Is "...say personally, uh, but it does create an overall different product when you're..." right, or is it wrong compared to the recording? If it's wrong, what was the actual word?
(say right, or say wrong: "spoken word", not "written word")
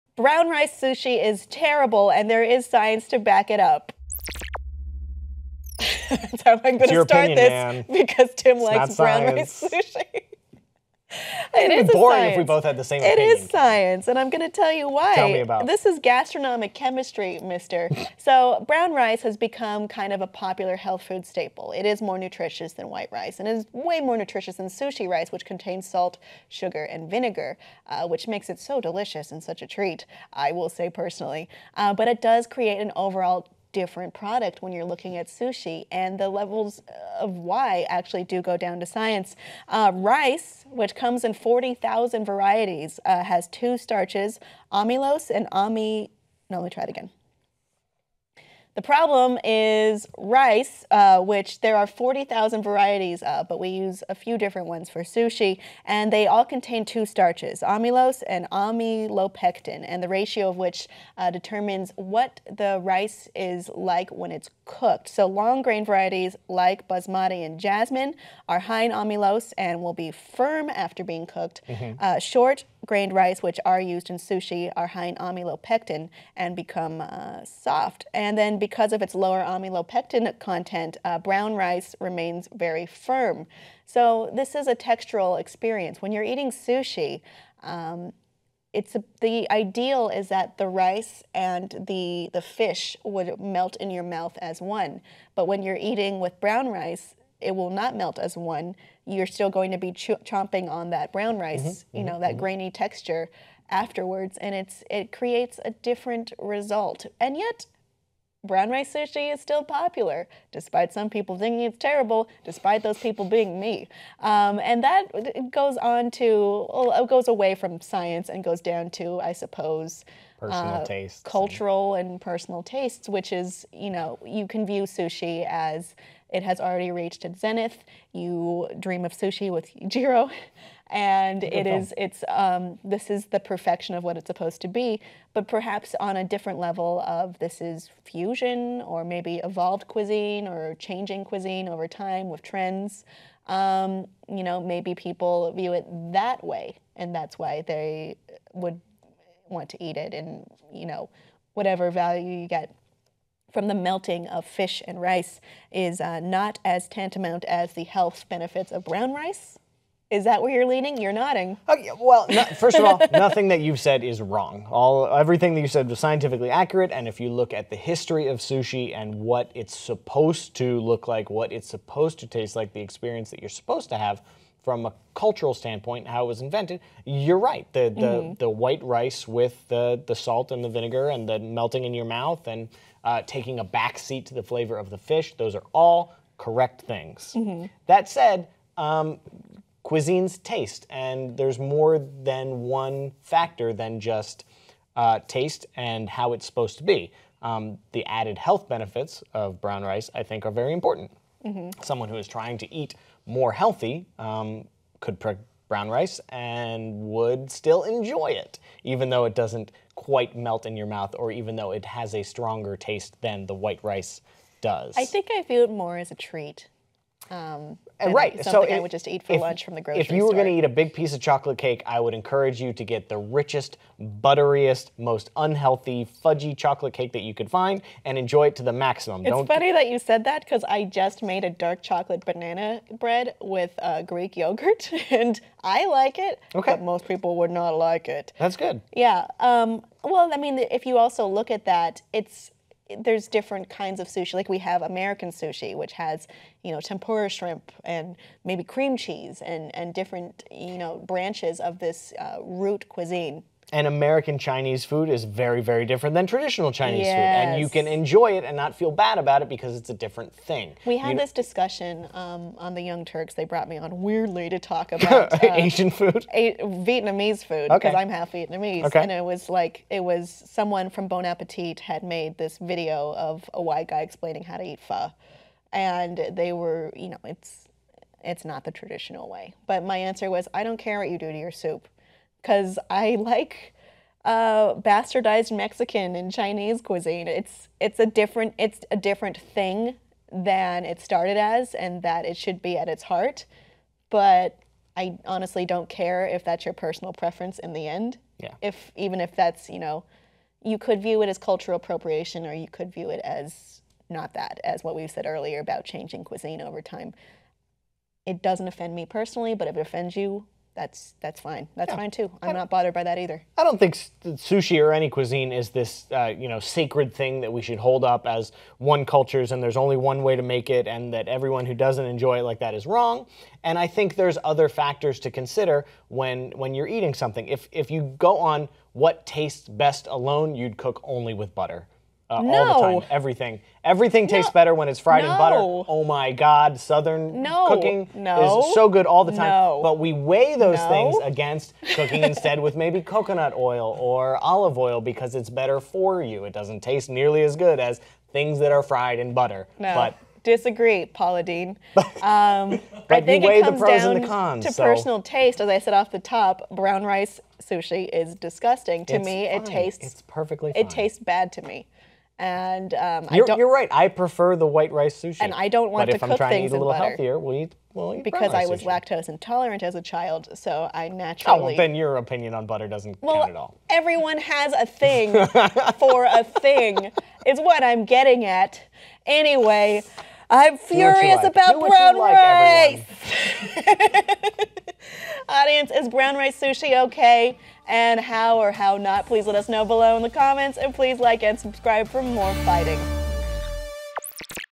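right.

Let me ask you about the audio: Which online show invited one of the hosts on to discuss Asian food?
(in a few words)
The Young Turks.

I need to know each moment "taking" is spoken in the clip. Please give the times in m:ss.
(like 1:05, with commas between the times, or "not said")
3:03.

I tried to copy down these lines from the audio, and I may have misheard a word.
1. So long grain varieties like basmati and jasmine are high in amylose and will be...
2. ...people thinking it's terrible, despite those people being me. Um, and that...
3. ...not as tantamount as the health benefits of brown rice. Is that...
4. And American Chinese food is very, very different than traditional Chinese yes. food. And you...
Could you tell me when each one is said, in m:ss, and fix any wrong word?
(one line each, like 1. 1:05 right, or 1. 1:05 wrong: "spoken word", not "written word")
1. 1:05 right
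2. 1:51 right
3. 2:36 right
4. 4:13 right.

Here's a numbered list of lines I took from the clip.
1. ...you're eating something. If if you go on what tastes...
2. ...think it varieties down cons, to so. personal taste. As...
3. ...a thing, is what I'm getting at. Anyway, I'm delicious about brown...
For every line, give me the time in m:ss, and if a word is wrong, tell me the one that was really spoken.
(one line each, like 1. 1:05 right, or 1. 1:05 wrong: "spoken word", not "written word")
1. 5:26 right
2. 5:53 wrong: "comes", not "varieties"
3. 6:16 wrong: "furious", not "delicious".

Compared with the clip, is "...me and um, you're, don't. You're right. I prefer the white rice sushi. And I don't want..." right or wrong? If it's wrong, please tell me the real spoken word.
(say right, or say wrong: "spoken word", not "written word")
right.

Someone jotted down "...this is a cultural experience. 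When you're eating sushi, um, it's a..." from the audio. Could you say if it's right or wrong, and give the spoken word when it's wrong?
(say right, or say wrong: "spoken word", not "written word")
wrong: "textural", not "cultural".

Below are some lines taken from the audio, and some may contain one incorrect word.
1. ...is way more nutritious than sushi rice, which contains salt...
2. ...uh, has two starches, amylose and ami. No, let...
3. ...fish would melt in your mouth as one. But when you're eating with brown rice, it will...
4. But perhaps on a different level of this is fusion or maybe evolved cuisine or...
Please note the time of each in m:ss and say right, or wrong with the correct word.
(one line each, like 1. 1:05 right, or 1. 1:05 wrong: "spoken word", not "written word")
1. 0:23 right
2. 0:43 right
3. 1:32 right
4. 2:15 right.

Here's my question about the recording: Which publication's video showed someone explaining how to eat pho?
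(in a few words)
Bon Appetit.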